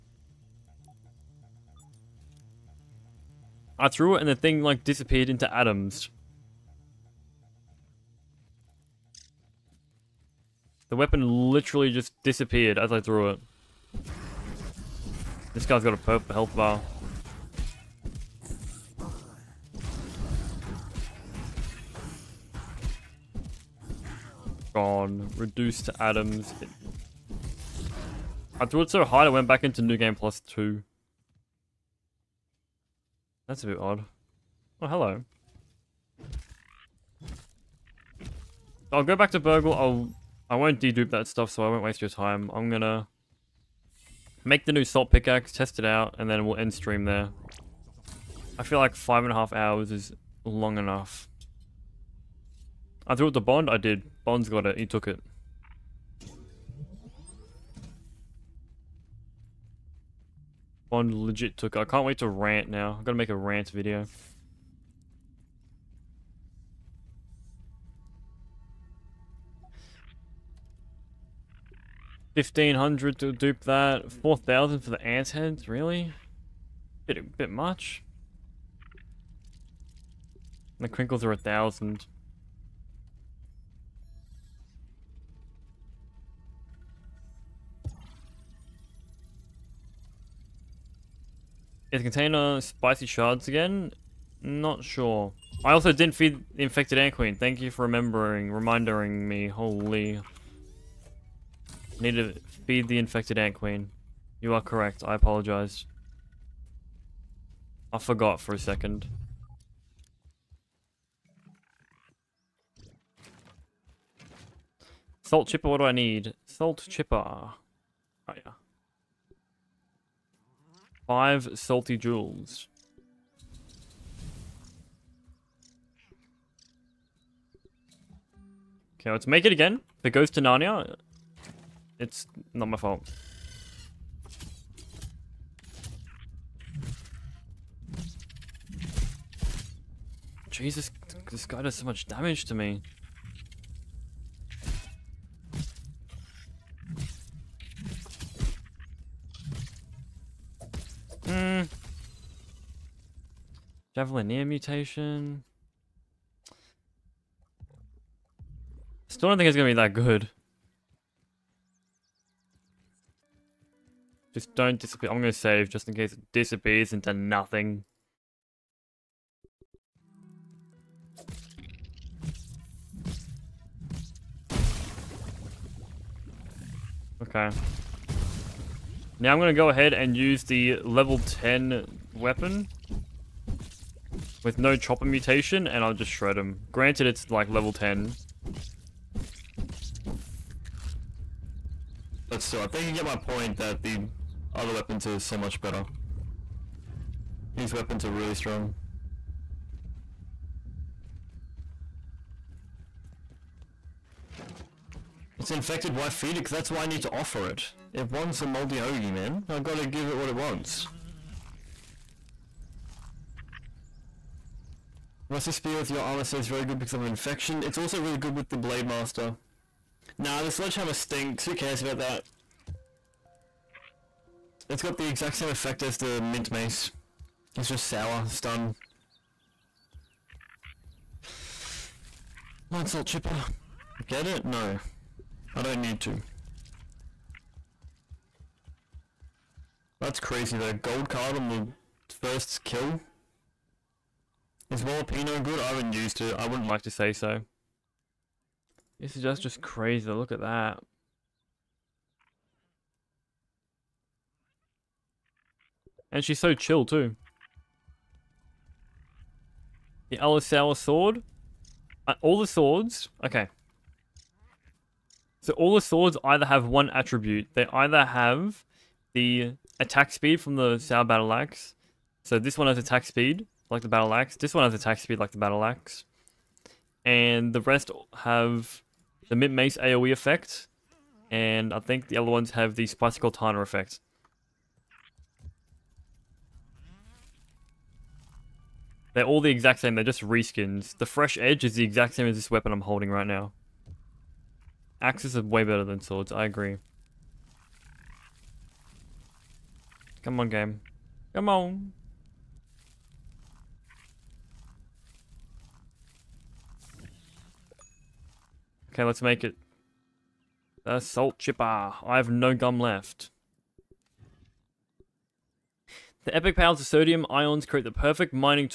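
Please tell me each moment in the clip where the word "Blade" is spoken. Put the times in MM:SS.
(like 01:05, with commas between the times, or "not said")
03:38.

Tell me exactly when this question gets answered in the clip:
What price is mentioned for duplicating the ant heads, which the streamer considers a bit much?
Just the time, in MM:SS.
01:14.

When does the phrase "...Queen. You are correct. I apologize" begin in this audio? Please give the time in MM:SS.
01:43.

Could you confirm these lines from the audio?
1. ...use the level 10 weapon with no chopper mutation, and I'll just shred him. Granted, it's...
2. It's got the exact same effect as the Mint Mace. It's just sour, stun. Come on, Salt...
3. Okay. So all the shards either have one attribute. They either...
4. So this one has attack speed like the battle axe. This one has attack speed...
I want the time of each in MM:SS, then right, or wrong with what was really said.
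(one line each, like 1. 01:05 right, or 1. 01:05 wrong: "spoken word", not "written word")
1. 03:00 right
2. 03:44 right
3. 04:23 wrong: "swords", not "shards"
4. 04:32 right.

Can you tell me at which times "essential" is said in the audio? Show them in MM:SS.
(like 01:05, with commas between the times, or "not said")
not said.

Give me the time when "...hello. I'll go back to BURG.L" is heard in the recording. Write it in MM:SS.
00:34.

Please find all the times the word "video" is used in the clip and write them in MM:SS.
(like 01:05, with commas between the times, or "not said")
01:03.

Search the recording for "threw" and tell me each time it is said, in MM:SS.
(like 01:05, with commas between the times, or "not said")
00:03, 00:13, 00:28, 00:53.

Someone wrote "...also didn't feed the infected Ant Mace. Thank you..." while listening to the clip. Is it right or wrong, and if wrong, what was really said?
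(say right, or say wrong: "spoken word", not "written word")
wrong: "Queen", not "Mace".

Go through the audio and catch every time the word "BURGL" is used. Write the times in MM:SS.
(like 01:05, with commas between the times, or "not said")
00:39.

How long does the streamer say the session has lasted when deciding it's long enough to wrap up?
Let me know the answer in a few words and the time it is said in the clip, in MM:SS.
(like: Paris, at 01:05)
5 and a half hours, at 00:48.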